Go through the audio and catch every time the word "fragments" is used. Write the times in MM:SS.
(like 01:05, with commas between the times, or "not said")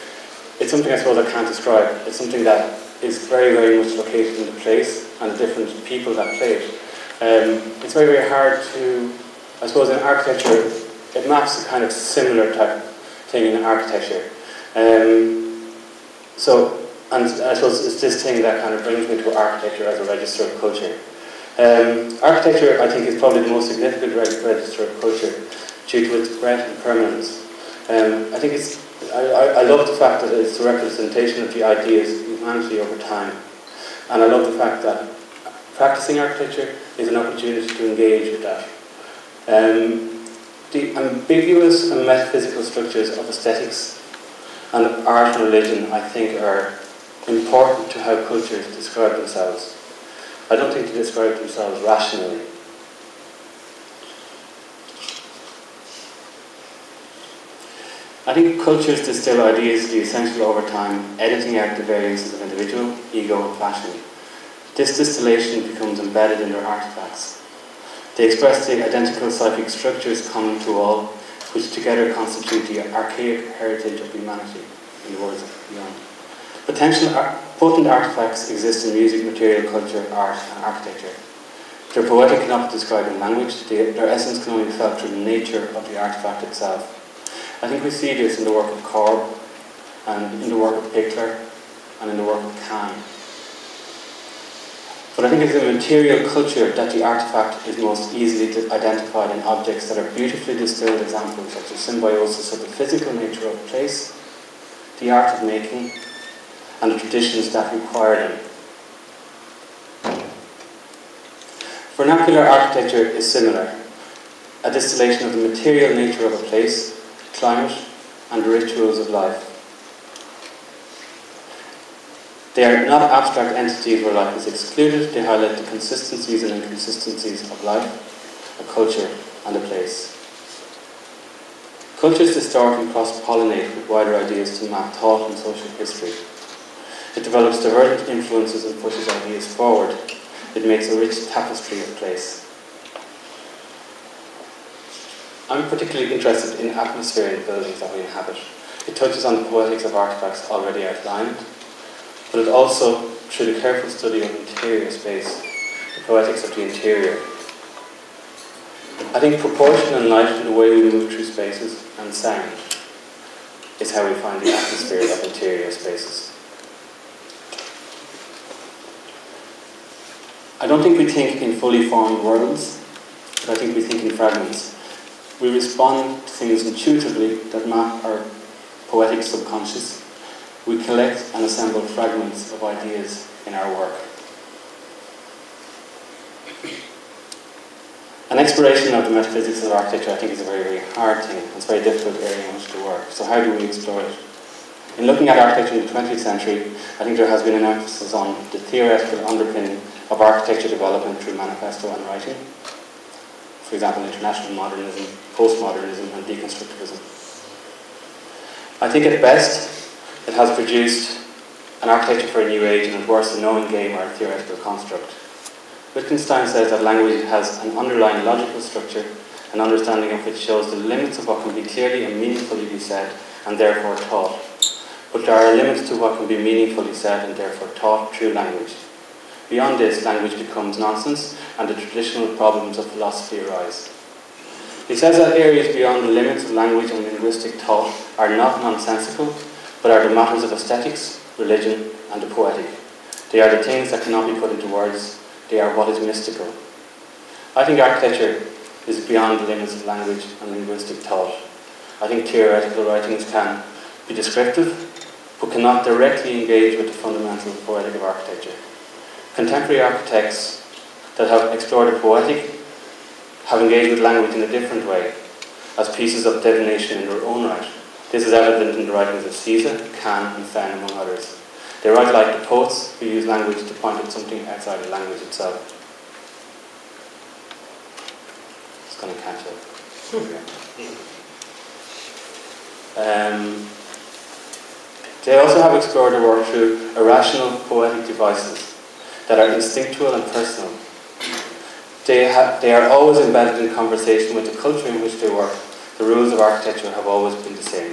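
02:54, 03:01.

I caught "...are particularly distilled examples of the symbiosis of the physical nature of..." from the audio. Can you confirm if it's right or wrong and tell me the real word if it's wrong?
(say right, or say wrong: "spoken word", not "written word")
wrong: "beautifully", not "particularly".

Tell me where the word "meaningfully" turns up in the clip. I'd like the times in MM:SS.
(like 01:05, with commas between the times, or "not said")
03:42, 03:46.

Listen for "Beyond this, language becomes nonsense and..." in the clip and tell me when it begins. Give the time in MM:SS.
03:49.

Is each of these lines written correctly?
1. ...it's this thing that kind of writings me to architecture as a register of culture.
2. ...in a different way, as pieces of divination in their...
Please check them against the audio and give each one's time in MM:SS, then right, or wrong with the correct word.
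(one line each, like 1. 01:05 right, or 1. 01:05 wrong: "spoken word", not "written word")
1. 00:17 wrong: "brings", not "writings"
2. 04:24 right.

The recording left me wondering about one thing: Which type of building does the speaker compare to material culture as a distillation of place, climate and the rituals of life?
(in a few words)
Vernacular architecture.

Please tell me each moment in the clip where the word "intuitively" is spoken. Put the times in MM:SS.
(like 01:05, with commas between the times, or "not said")
02:56.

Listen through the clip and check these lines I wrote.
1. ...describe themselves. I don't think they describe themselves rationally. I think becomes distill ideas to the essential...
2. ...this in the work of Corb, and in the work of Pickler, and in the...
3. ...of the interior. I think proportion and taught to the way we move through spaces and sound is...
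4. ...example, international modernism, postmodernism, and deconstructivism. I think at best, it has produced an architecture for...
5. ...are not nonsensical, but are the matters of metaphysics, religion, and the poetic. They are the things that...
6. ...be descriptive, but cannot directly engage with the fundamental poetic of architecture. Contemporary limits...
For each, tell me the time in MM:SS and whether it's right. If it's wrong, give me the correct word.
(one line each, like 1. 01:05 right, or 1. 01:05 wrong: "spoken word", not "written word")
1. 00:48 wrong: "cultures", not "becomes"
2. 01:28 right
3. 02:36 wrong: "light", not "taught"
4. 03:23 right
5. 03:58 wrong: "aesthetics", not "metaphysics"
6. 04:14 wrong: "architects", not "limits".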